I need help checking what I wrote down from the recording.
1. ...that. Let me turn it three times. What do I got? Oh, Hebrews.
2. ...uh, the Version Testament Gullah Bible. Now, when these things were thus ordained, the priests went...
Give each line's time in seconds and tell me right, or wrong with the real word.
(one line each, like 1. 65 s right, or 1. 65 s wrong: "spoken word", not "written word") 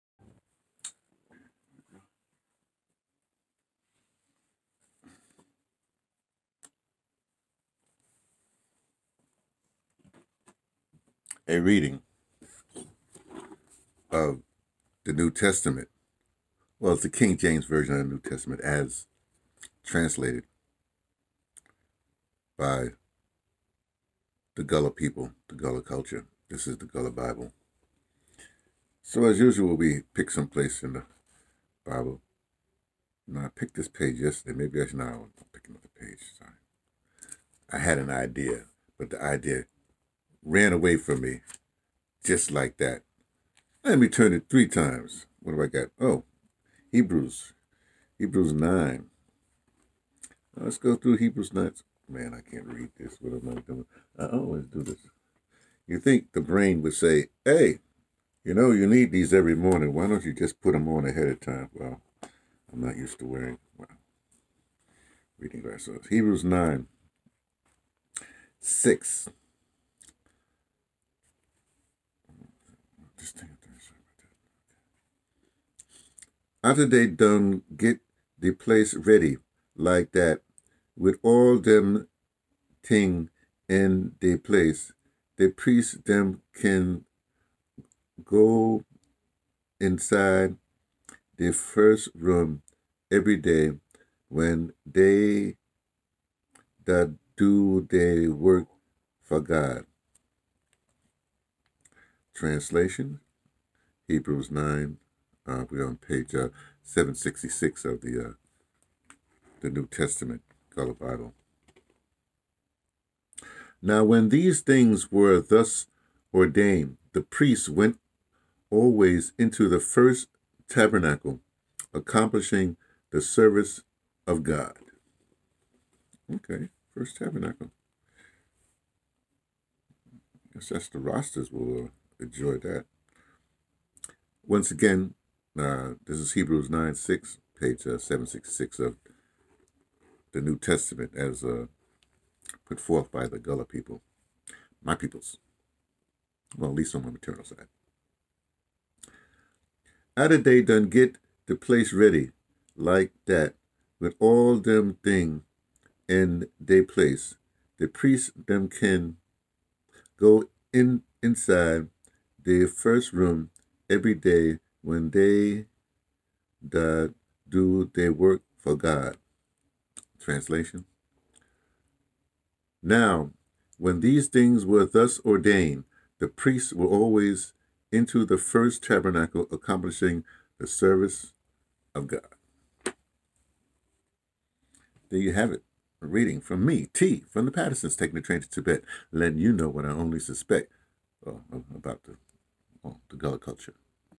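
1. 42 s right
2. 108 s wrong: "New", not "Version".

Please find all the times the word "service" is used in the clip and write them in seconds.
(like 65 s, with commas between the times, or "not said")
123 s, 180 s.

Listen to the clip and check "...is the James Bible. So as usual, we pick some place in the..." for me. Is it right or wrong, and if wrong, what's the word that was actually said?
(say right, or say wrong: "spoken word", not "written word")
wrong: "Gullah", not "James".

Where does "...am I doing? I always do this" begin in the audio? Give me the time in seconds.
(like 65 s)
53 s.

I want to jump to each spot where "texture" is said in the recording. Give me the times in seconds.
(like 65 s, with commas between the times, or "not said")
not said.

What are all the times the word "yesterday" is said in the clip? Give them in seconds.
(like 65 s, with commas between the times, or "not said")
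34 s.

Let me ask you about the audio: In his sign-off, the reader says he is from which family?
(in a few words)
the Pattersons.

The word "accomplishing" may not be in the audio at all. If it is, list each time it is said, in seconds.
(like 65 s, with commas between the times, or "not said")
121 s, 179 s.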